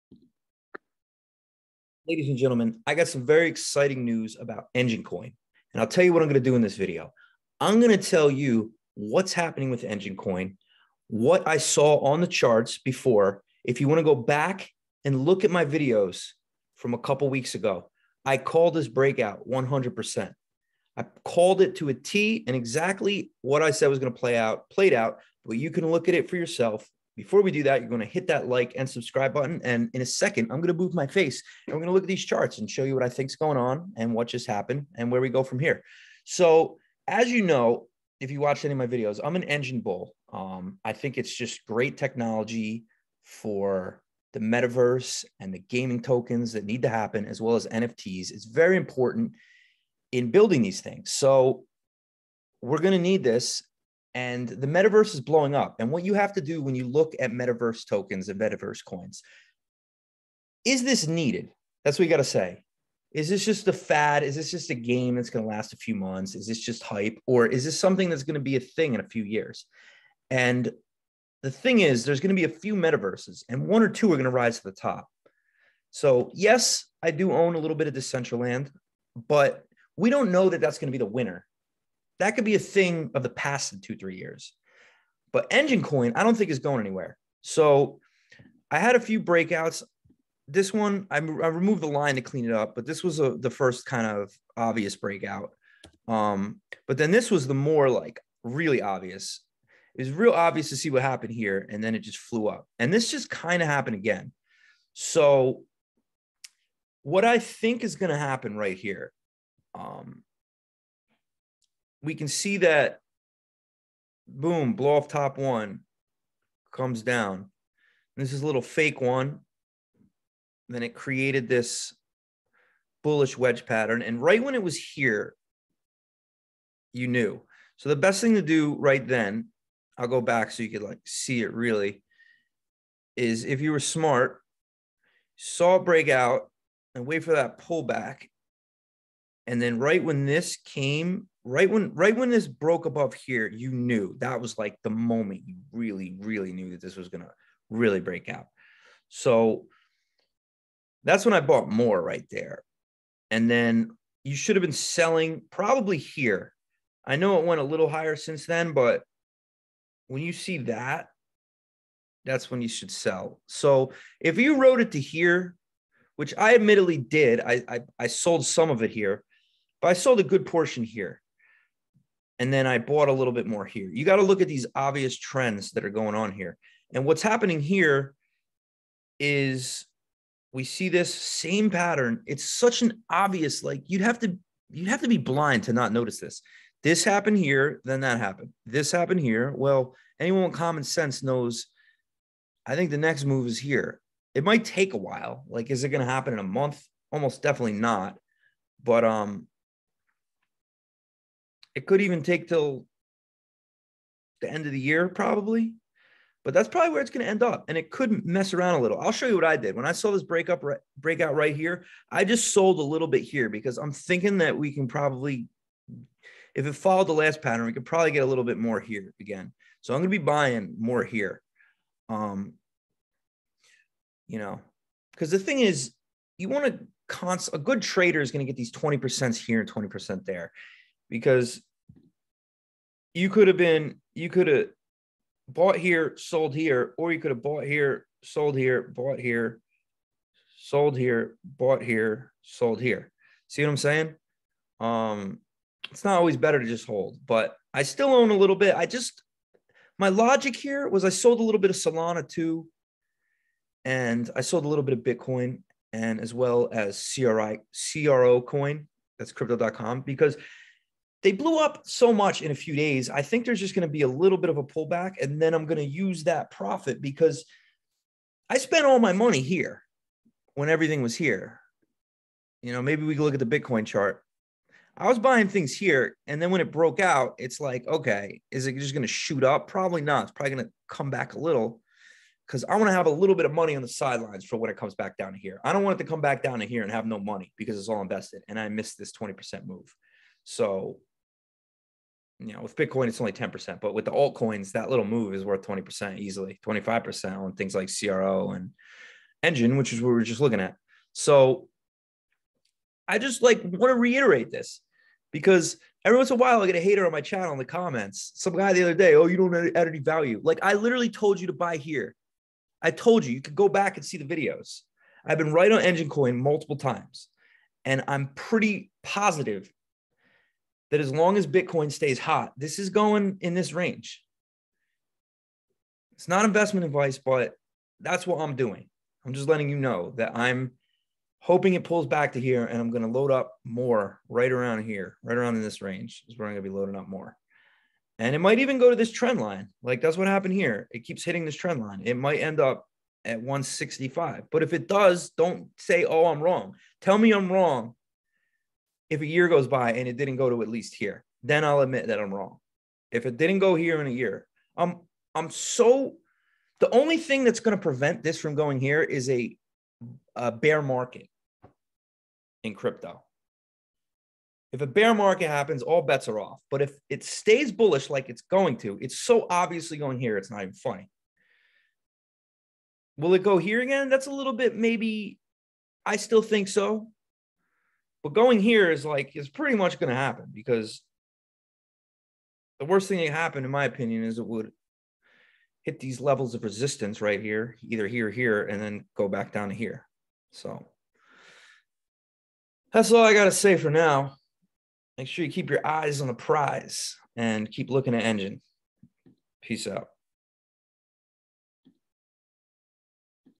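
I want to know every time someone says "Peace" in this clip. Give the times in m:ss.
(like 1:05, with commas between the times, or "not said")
6:39.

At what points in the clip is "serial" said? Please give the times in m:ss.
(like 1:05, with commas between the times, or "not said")
not said.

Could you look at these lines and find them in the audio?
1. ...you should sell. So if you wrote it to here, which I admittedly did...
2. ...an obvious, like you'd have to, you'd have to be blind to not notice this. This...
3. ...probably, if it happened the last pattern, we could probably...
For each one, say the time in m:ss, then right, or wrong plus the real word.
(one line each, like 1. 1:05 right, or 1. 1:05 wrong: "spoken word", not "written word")
1. 2:42 right
2. 3:02 right
3. 3:34 wrong: "followed", not "happened".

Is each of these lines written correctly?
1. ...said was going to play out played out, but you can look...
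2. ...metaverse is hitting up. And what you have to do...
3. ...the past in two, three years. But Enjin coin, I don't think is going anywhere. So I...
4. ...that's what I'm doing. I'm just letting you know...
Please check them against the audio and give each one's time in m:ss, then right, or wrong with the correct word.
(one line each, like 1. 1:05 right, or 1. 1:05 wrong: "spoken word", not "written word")
1. 0:23 right
2. 0:54 wrong: "blowing", not "hitting"
3. 1:23 right
4. 5:28 right.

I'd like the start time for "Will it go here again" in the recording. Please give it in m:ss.
6:13.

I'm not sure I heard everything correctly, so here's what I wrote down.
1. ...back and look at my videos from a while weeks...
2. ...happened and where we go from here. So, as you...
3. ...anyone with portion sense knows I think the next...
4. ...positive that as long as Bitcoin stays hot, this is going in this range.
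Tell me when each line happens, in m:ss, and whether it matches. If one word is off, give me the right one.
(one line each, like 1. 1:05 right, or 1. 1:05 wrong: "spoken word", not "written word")
1. 0:14 wrong: "couple", not "while"
2. 0:34 right
3. 3:10 wrong: "common", not "portion"
4. 5:19 right.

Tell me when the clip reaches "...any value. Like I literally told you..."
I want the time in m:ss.
5:09.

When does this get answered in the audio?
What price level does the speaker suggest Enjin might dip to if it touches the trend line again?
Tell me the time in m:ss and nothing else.
5:43.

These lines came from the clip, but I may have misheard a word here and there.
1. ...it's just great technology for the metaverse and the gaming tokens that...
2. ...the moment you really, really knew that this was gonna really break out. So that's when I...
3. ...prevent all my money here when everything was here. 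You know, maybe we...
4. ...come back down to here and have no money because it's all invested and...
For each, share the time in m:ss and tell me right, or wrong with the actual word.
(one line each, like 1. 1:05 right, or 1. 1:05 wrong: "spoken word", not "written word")
1. 0:41 right
2. 2:24 right
3. 4:28 wrong: "spent", not "prevent"
4. 4:46 right.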